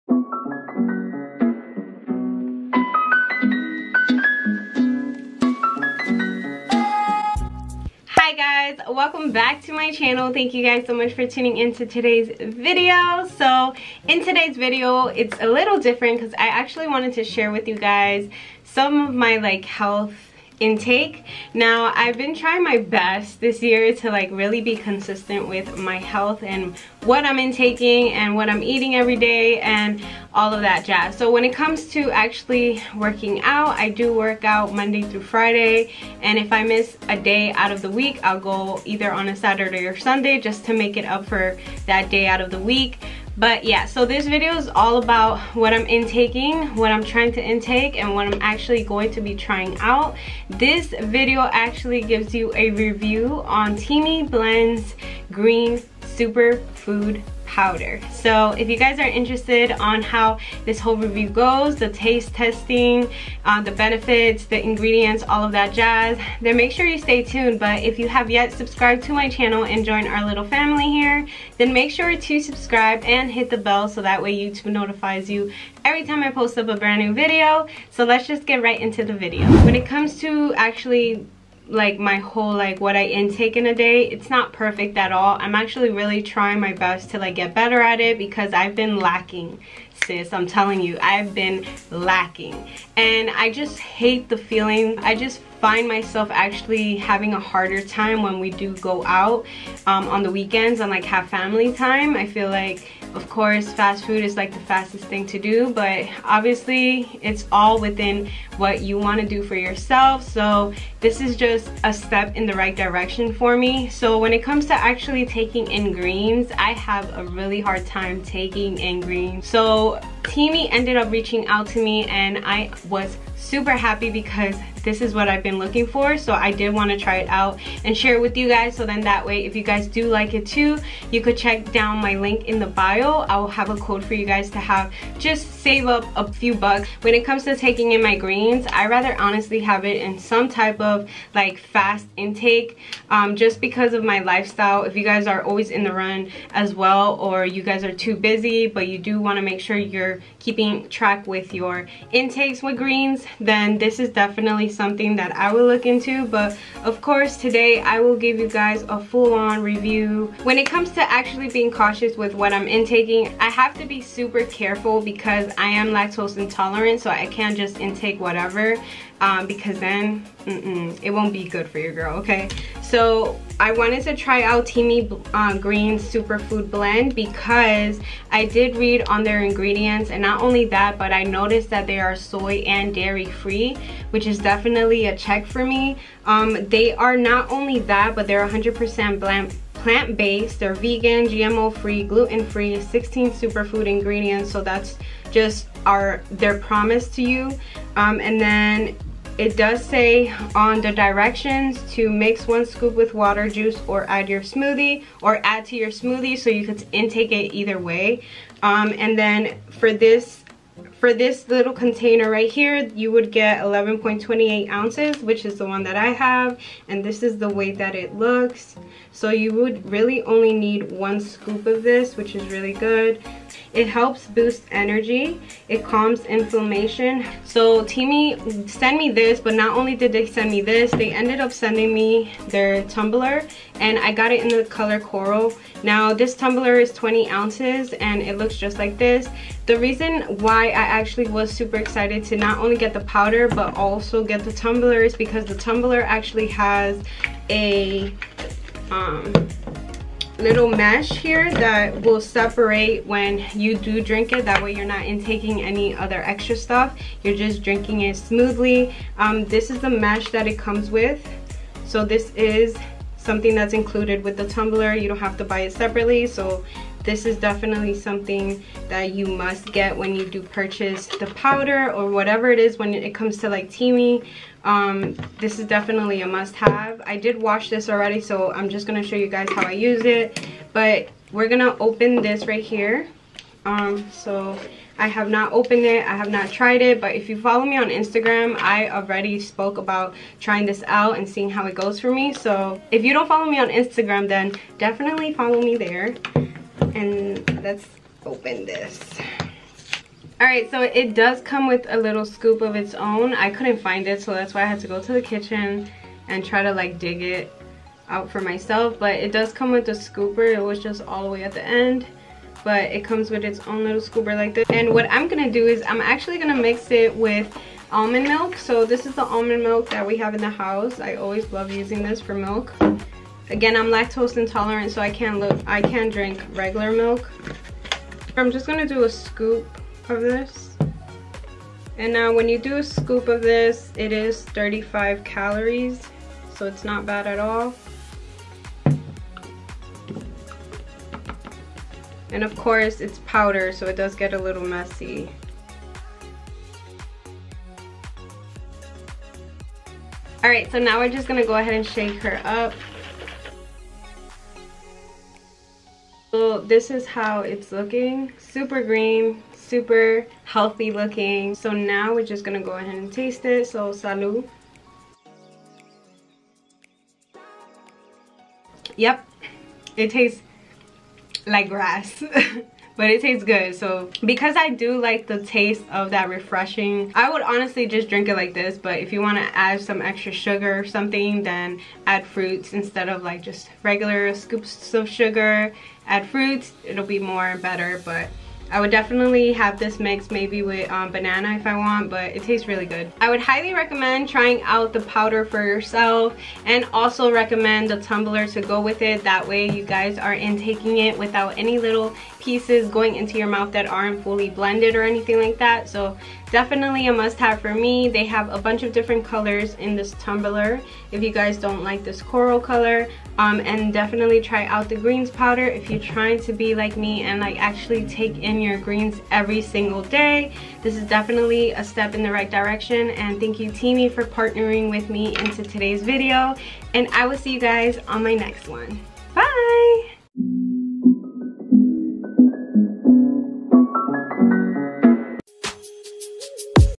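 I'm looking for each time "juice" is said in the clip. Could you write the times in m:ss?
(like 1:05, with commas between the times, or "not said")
3:23.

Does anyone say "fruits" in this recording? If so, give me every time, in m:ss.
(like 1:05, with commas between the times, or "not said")
6:22, 6:26.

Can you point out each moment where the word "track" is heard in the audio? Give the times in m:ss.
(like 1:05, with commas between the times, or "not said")
2:30.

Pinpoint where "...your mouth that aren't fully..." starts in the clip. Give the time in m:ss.
6:43.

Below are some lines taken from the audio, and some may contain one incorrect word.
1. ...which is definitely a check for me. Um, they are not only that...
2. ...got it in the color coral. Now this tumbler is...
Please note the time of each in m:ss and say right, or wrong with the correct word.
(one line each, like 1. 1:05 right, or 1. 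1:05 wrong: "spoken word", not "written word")
1. 3:04 right
2. 3:54 right.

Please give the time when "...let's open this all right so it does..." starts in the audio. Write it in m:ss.
4:57.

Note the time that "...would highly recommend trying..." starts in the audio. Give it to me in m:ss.
6:33.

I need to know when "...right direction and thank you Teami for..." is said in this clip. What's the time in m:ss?
7:02.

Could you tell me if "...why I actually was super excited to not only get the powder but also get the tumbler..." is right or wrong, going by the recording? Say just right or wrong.
right.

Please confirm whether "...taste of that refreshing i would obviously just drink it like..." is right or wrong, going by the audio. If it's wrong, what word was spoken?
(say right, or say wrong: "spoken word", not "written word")
wrong: "honestly", not "obviously".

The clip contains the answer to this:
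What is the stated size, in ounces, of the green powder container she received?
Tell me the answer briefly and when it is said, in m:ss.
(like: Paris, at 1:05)
11.28 ounces, at 3:33.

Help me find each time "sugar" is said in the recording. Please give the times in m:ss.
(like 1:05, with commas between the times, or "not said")
6:20, 6:25.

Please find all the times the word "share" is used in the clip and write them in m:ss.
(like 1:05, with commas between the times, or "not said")
0:17, 2:07.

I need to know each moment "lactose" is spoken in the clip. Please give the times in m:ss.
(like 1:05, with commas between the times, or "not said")
2:45, 5:23.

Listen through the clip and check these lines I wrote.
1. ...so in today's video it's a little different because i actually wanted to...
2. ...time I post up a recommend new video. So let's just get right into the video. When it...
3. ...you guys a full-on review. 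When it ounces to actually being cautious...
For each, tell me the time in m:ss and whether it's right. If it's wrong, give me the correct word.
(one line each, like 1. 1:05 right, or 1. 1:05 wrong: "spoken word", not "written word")
1. 0:13 right
2. 1:16 wrong: "brand", not "recommend"
3. 2:38 wrong: "comes", not "ounces".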